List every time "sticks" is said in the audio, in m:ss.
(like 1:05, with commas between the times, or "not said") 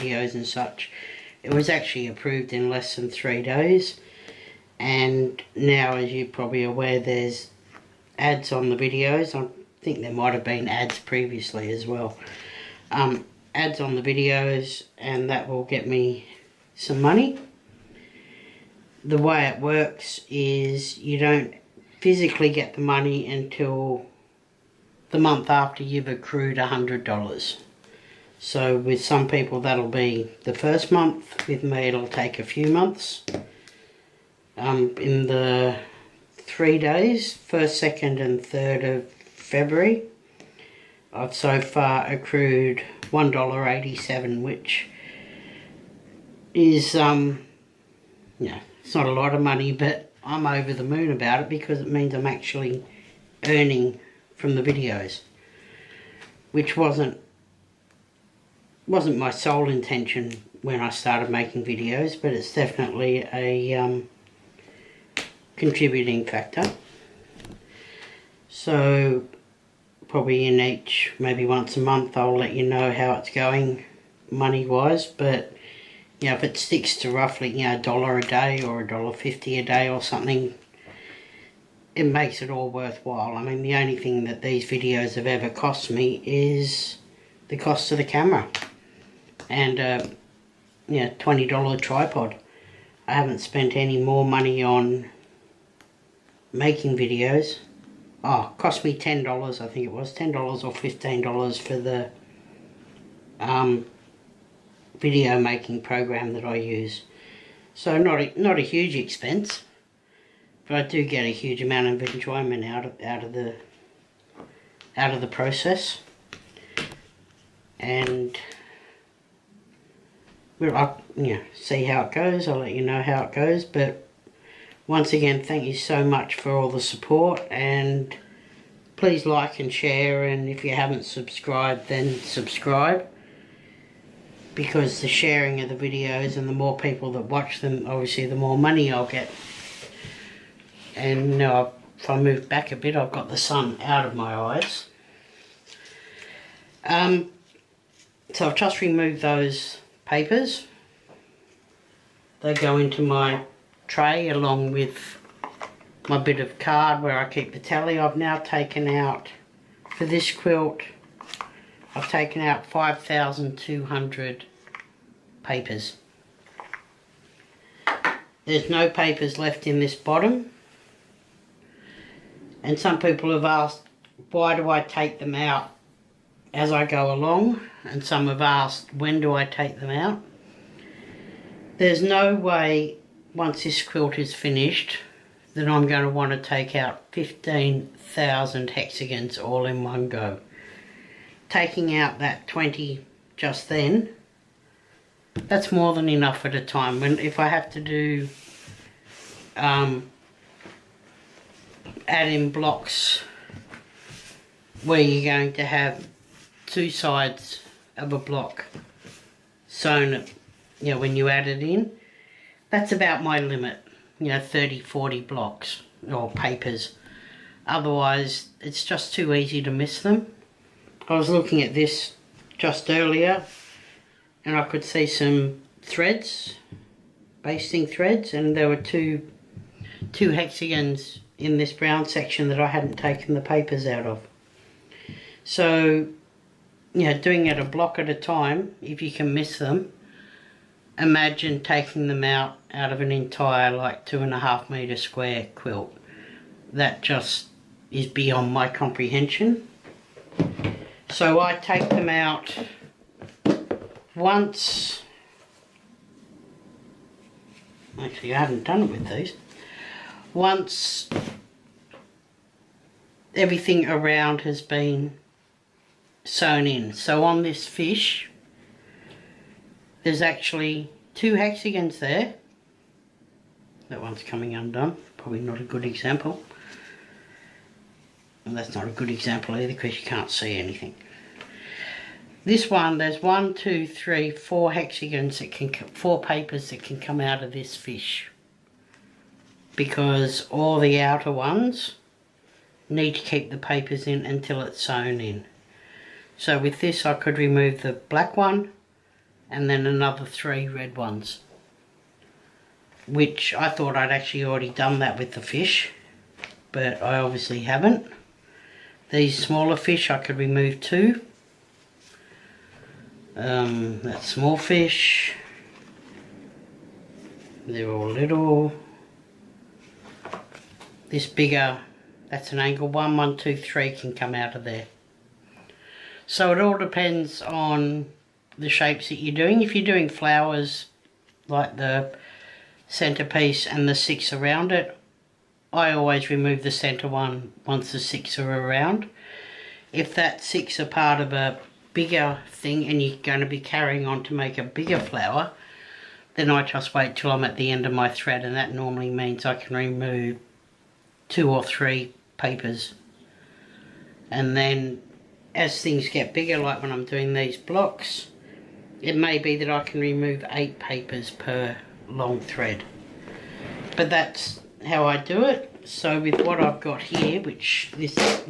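1:16.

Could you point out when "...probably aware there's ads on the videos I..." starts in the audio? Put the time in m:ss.
0:06.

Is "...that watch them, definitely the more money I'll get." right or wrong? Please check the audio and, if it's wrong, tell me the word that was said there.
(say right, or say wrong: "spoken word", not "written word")
wrong: "obviously", not "definitely".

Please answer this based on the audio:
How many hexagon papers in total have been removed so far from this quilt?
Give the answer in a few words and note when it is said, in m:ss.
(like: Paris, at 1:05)
5,200, at 2:42.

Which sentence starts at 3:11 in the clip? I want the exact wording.
Taking out that 20 just then, that's more than enough at a time.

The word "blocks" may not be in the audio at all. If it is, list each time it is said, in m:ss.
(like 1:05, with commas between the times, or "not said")
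3:22, 3:28, 3:35, 3:57, 5:57.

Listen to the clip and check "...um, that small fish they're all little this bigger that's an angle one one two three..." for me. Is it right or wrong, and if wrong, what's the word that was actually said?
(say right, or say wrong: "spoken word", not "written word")
right.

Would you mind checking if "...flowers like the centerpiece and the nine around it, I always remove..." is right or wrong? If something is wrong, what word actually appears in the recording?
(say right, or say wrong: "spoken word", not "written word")
wrong: "six", not "nine".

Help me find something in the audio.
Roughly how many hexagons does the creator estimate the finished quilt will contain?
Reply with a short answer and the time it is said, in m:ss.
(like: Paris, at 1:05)
15,000, at 3:07.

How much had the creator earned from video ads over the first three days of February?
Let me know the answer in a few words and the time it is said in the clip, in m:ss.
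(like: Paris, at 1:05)
$1.87, at 0:43.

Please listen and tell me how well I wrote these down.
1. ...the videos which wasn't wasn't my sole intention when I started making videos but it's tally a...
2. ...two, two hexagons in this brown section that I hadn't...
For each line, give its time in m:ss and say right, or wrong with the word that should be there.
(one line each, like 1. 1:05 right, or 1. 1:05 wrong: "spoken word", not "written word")
1. 0:54 wrong: "definitely", not "tally"
2. 3:48 right.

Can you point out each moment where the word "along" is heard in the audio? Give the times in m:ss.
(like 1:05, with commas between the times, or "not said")
2:34, 2:57.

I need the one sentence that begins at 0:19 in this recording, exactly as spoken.
The way it works is you don't physically get the money until the month after you've accrued $100.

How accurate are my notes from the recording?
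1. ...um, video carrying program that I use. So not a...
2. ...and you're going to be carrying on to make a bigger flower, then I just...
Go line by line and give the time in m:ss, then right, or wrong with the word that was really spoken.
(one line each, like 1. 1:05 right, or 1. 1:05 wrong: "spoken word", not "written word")
1. 1:43 wrong: "making", not "carrying"
2. 5:42 right.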